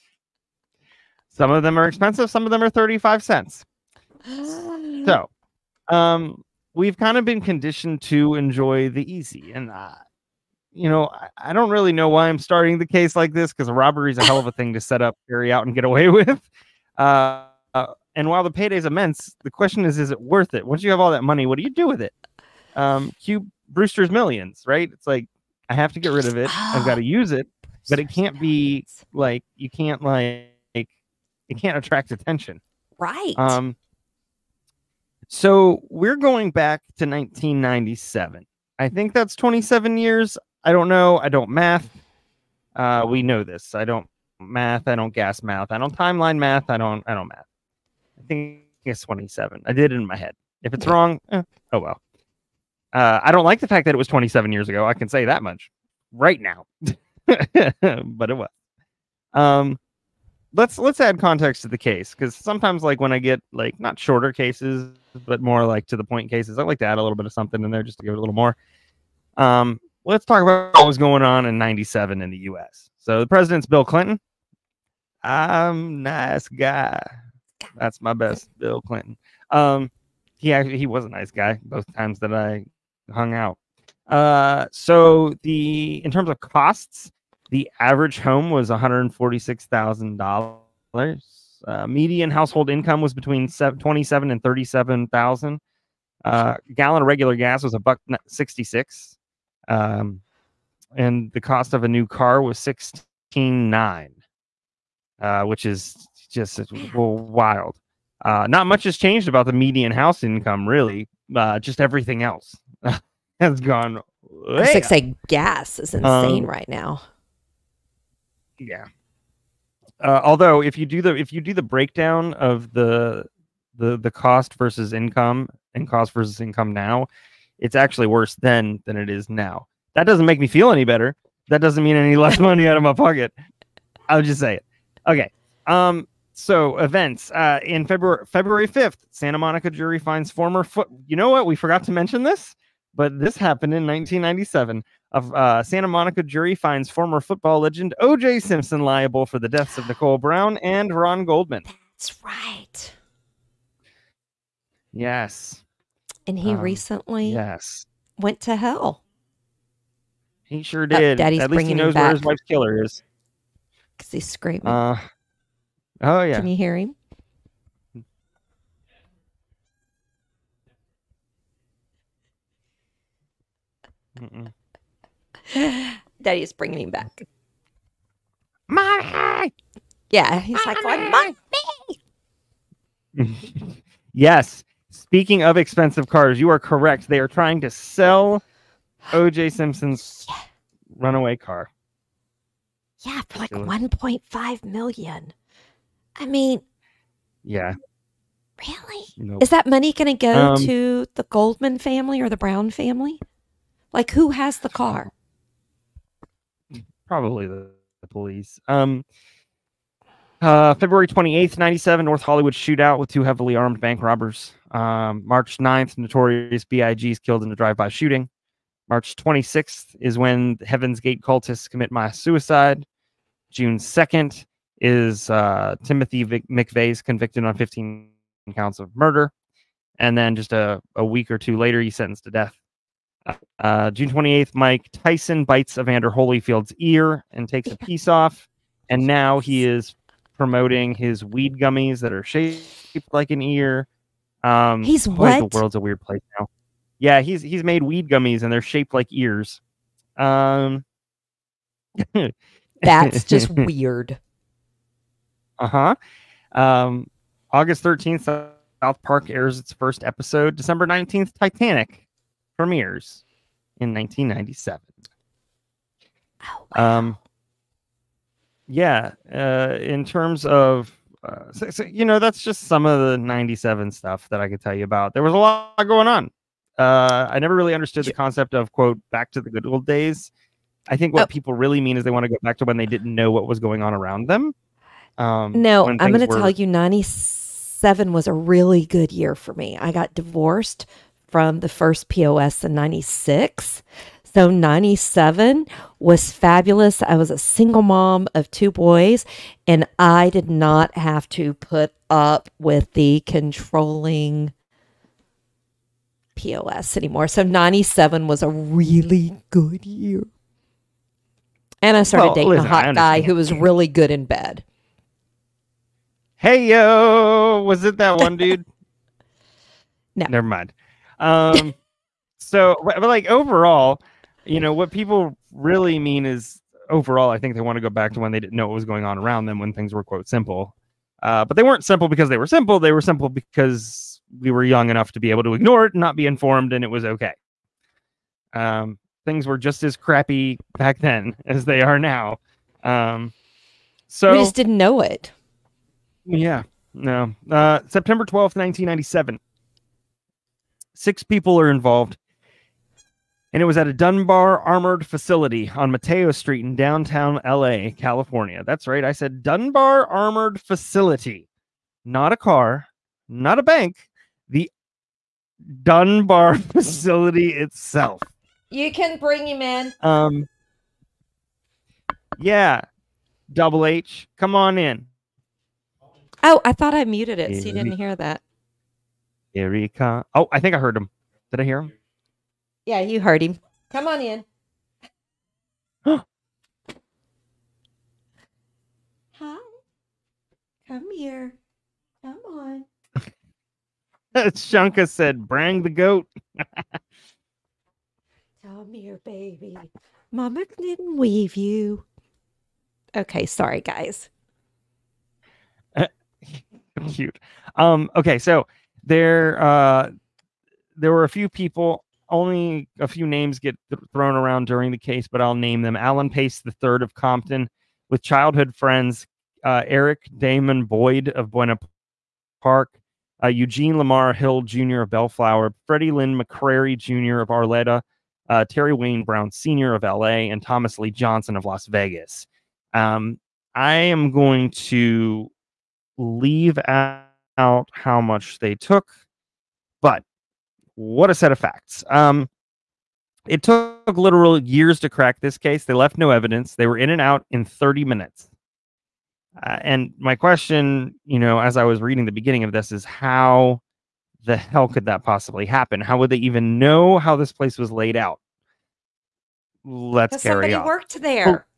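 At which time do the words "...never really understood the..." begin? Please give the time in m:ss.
4:37.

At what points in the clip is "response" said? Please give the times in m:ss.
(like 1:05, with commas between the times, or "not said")
not said.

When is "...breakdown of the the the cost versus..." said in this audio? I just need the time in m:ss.
2:01.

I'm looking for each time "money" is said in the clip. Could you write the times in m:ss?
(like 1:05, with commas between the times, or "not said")
0:21, 2:12, 3:19.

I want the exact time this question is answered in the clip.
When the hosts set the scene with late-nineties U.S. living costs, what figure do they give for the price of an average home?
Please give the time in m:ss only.
1:28.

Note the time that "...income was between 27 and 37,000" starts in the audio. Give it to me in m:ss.
1:32.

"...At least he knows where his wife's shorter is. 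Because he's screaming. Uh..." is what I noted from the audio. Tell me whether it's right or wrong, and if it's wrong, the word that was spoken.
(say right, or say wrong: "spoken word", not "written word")
wrong: "killer", not "shorter".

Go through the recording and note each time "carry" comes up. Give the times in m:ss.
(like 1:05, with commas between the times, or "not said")
0:15, 7:40.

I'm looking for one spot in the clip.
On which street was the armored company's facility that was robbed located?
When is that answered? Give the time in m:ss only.
5:55.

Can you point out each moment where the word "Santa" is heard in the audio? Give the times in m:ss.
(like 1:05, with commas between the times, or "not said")
2:19, 2:25.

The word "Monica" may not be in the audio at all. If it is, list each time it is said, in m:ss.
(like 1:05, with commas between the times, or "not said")
2:19, 2:25.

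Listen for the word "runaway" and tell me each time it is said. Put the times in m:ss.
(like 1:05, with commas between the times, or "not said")
3:10.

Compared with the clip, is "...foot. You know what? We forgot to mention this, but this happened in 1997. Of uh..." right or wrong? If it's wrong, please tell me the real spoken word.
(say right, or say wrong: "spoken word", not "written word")
right.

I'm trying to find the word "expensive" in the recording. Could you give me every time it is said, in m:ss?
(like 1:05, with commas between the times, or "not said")
0:01, 3:05.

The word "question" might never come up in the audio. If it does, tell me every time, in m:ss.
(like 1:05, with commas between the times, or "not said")
0:19, 7:30.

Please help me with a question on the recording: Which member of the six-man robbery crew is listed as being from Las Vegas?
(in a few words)
Thomas Lee Johnson.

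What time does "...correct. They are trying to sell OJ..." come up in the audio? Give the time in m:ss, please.
3:06.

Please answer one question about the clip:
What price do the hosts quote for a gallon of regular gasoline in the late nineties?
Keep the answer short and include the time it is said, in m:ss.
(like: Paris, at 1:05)
$1.66, at 1:37.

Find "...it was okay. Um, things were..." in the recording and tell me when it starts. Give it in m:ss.
5:36.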